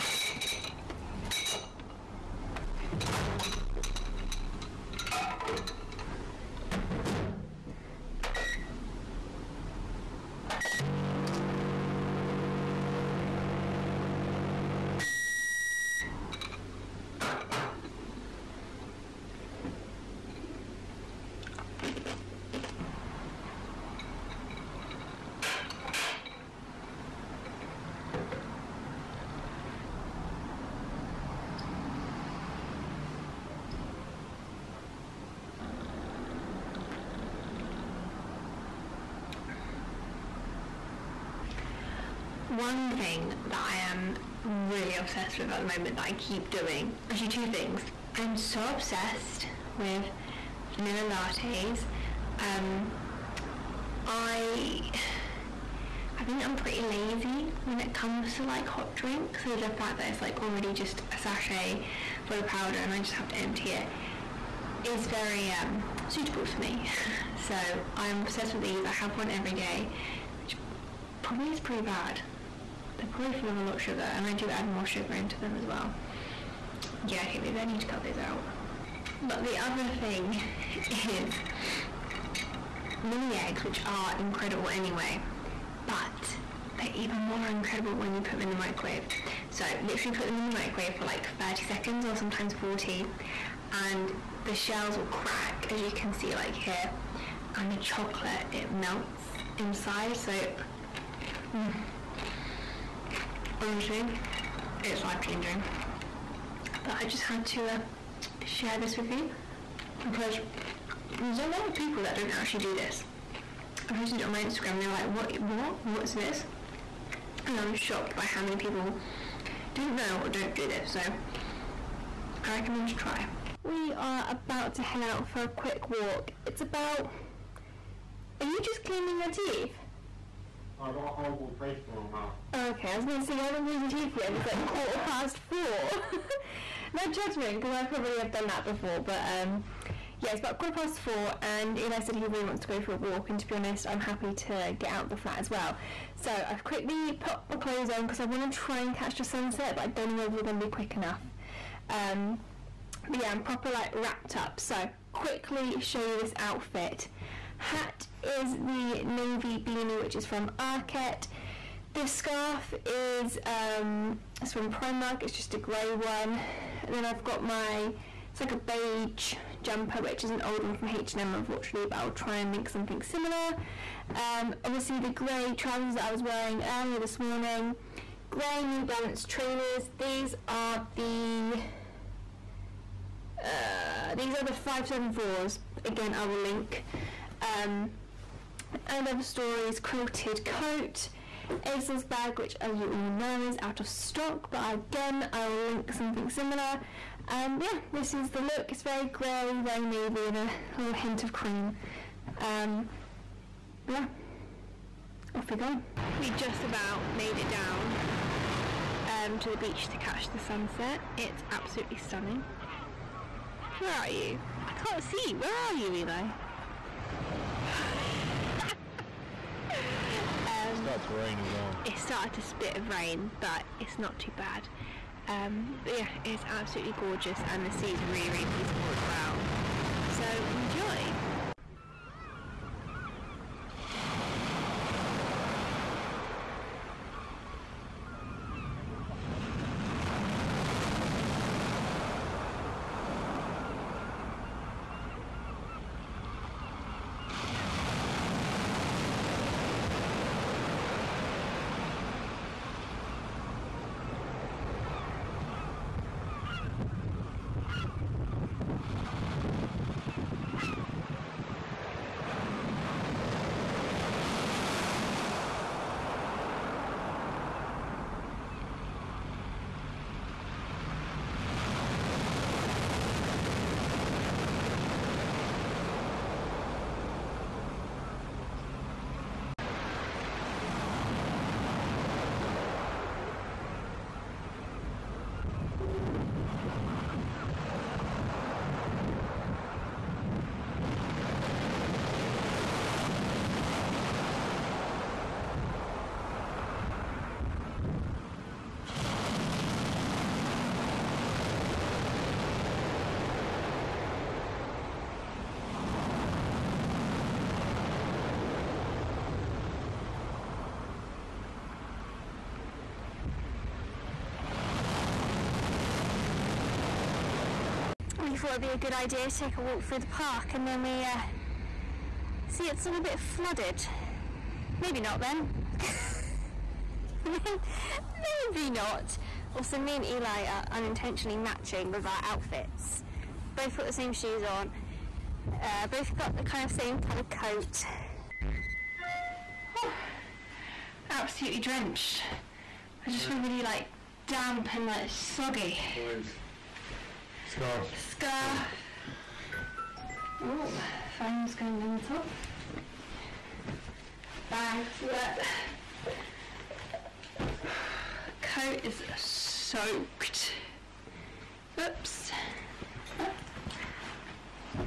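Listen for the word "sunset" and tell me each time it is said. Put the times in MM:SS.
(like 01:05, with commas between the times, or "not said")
02:29, 03:30.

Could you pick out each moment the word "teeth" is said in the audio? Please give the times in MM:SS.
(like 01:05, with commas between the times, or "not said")
02:09, 02:13.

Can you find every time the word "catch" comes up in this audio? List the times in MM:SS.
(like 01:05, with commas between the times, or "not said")
02:28, 03:29.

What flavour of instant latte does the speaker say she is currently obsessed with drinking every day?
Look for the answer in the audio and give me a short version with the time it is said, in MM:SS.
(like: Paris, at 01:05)
vanilla, at 00:50.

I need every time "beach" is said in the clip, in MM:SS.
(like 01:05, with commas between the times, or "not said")
03:29.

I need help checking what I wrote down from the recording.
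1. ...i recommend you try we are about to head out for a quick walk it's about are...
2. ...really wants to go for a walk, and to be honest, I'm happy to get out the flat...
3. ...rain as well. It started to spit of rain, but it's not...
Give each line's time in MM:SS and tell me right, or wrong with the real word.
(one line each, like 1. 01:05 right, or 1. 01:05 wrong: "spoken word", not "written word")
1. 02:02 right
2. 02:22 right
3. 03:41 right.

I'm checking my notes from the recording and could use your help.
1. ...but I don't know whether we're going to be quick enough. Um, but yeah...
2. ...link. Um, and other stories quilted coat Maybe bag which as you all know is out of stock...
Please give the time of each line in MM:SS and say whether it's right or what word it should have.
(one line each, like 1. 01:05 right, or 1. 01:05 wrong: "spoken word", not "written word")
1. 02:29 right
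2. 03:06 wrong: "ASOS", not "Maybe".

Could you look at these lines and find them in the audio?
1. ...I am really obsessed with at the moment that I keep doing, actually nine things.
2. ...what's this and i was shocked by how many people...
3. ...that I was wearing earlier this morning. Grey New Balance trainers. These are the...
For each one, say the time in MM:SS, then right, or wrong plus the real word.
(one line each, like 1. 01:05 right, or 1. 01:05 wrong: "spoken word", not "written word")
1. 00:43 wrong: "two", not "nine"
2. 01:55 right
3. 02:55 right.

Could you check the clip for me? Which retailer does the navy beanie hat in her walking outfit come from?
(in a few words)
Arket.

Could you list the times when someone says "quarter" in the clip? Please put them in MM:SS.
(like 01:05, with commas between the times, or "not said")
02:14, 02:20.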